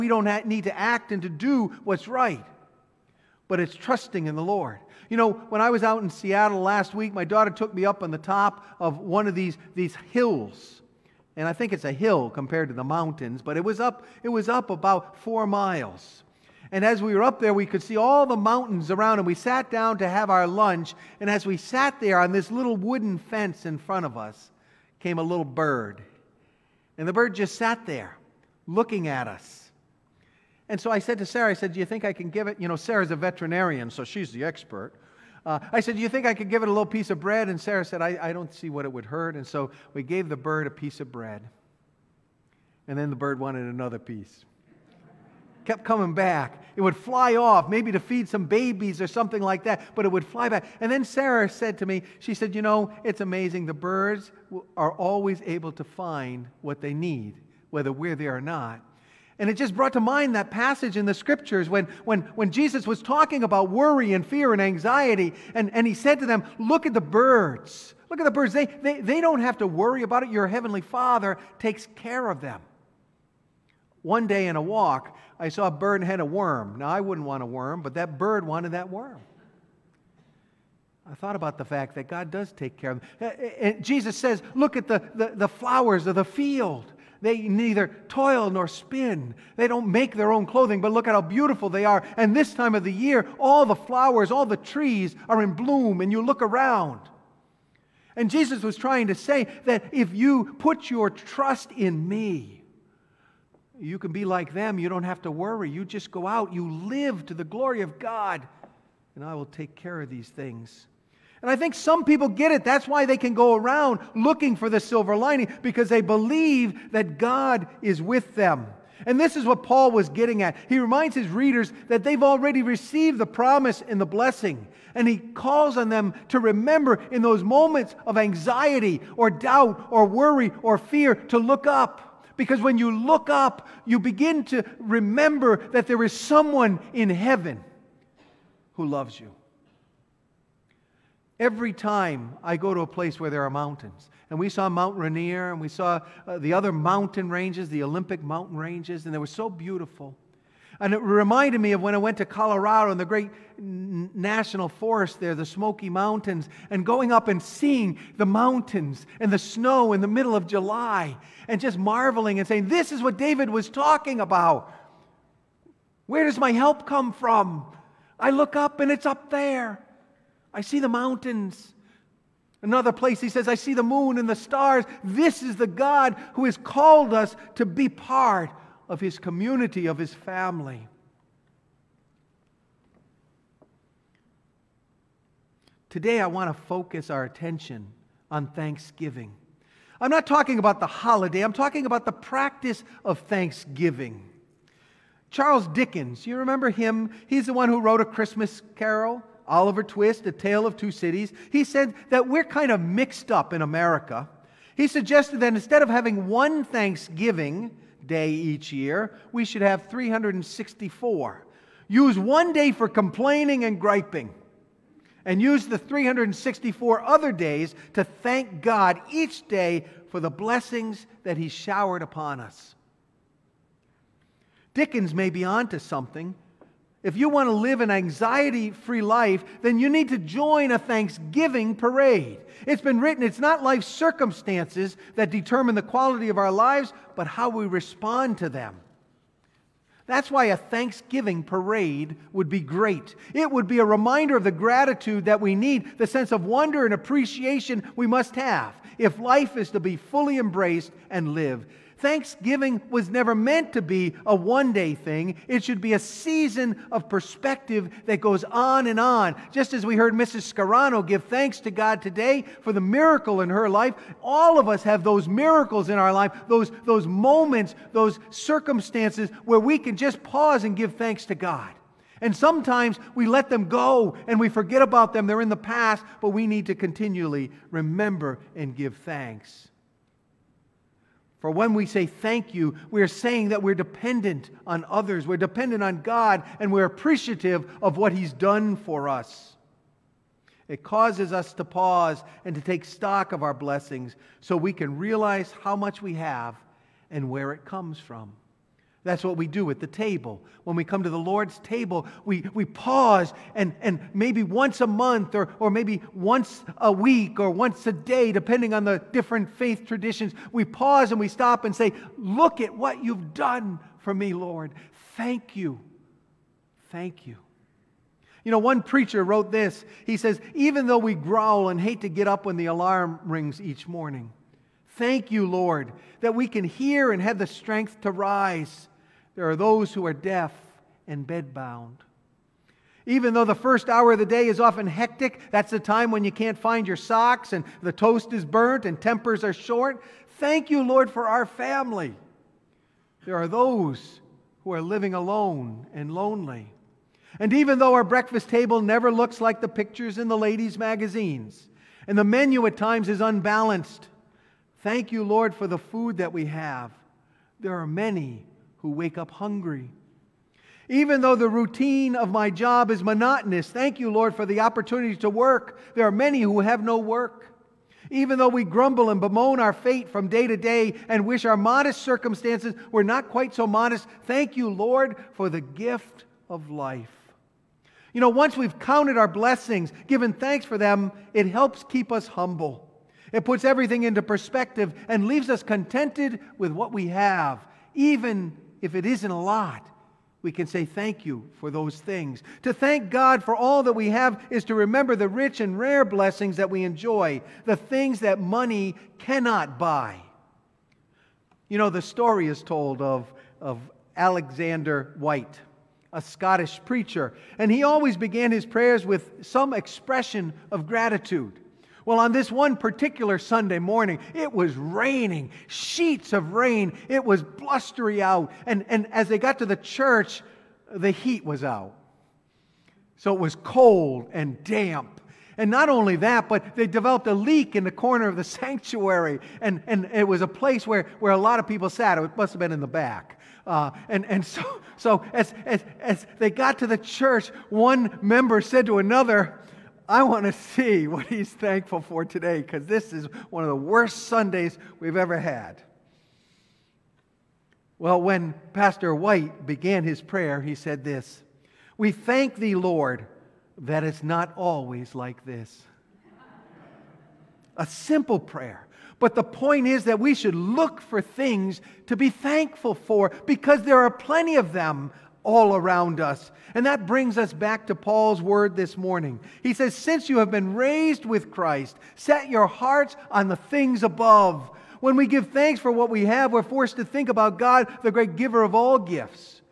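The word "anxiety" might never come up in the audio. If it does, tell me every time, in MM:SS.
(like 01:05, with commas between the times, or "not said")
01:04, 02:08, 03:47.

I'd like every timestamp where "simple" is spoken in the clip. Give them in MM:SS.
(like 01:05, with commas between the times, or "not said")
07:37.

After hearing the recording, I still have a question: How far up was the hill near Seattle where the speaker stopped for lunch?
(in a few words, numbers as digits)
4 miles.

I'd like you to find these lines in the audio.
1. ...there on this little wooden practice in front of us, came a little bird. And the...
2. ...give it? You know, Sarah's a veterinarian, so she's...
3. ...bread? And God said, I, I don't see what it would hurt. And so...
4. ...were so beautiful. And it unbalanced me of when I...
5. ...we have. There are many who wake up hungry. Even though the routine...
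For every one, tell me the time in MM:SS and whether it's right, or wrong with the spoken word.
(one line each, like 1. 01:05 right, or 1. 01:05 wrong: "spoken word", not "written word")
1. 00:21 wrong: "fence", not "practice"
2. 00:32 right
3. 00:37 wrong: "Sarah", not "God"
4. 02:29 wrong: "reminded", not "unbalanced"
5. 05:56 right.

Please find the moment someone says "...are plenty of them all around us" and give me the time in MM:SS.
07:43.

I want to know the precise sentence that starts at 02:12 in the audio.
Because when you look up, you begin to remember that there is someone in heaven who loves you.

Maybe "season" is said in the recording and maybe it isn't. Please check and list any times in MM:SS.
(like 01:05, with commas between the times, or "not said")
04:15.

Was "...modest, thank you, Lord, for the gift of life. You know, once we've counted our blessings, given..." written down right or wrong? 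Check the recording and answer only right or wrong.
right.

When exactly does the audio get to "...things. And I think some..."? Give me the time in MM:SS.
01:50.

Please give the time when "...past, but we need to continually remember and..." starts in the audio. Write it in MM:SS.
04:35.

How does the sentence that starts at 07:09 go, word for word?
And, and it was a place where, where a lot of people sat.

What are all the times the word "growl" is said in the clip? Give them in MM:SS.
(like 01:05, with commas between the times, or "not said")
05:21.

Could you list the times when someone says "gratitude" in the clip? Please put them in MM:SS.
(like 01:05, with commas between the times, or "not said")
04:04, 06:50.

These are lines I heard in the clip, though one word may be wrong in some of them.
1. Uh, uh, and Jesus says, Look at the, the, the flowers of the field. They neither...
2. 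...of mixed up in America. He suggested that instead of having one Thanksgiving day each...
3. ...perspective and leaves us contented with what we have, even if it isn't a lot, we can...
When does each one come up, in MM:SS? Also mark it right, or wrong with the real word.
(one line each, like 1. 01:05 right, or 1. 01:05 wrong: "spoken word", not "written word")
1. 01:23 right
2. 03:22 right
3. 06:24 right.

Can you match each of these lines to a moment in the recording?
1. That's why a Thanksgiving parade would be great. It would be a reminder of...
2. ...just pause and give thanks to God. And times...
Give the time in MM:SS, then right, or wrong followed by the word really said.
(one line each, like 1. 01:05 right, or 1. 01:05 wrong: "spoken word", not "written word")
1. 04:00 right
2. 04:29 wrong: "sometimes", not "times".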